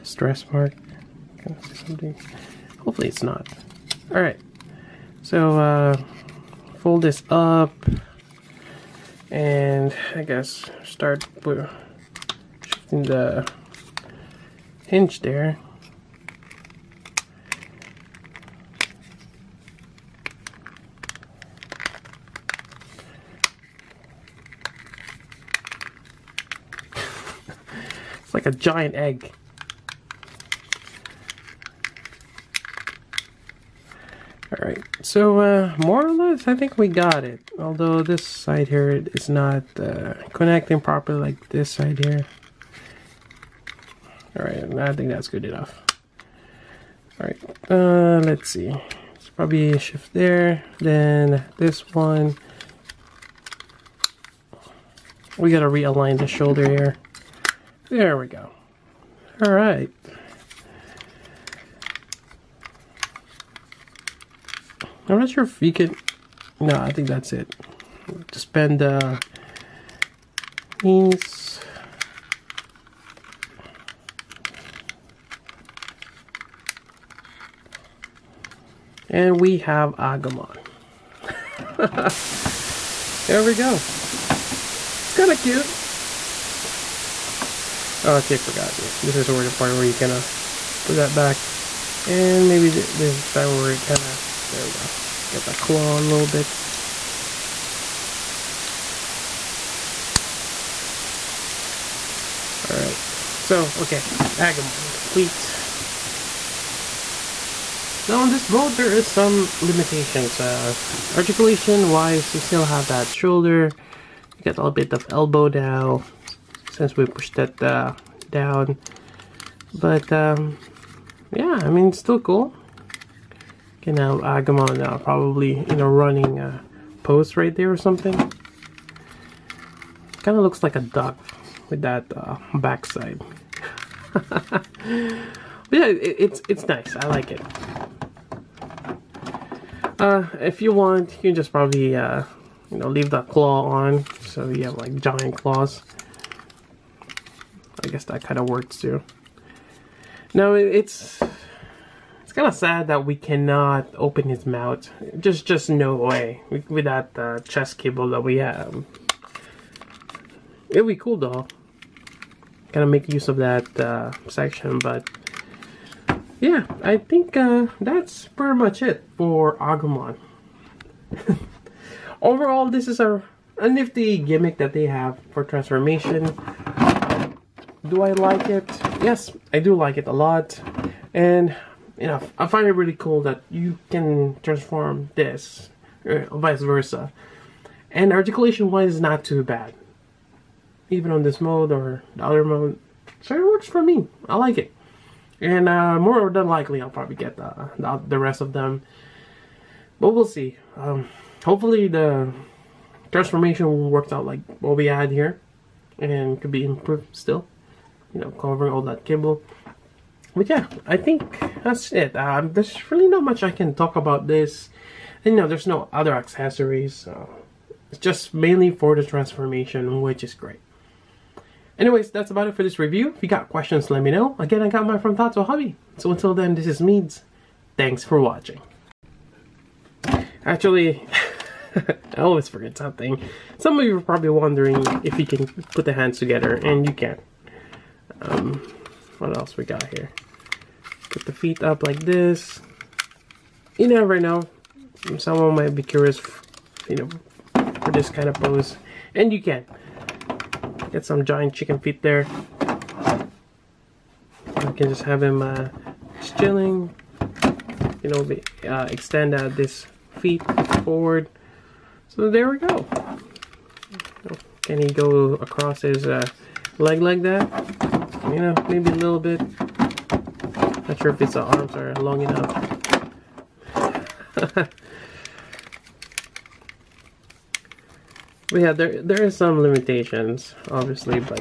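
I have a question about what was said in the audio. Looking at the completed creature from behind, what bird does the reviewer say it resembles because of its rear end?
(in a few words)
a duck.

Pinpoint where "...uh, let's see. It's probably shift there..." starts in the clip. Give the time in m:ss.
0:47.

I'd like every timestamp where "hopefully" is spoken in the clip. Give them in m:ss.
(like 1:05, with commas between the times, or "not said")
0:02, 3:21.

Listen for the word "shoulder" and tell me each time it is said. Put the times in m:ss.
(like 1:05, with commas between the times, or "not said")
0:56, 1:53.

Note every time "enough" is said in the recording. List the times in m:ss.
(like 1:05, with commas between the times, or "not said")
0:45, 4:32.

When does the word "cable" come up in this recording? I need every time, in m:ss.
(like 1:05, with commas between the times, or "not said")
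2:37, 3:29.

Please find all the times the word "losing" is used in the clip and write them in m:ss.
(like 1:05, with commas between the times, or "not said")
not said.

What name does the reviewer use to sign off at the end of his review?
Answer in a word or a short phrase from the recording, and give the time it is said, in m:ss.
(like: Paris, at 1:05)
Meads, at 3:46.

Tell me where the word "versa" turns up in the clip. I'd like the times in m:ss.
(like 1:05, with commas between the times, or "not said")
3:06.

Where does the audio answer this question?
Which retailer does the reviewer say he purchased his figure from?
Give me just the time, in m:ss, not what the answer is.
3:45.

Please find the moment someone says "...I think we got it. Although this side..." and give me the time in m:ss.
0:36.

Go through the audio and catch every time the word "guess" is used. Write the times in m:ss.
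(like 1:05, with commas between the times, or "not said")
0:10, 2:27.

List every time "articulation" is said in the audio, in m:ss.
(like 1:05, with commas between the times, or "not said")
1:51, 3:08.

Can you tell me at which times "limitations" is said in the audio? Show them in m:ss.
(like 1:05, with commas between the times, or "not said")
1:49, 4:39.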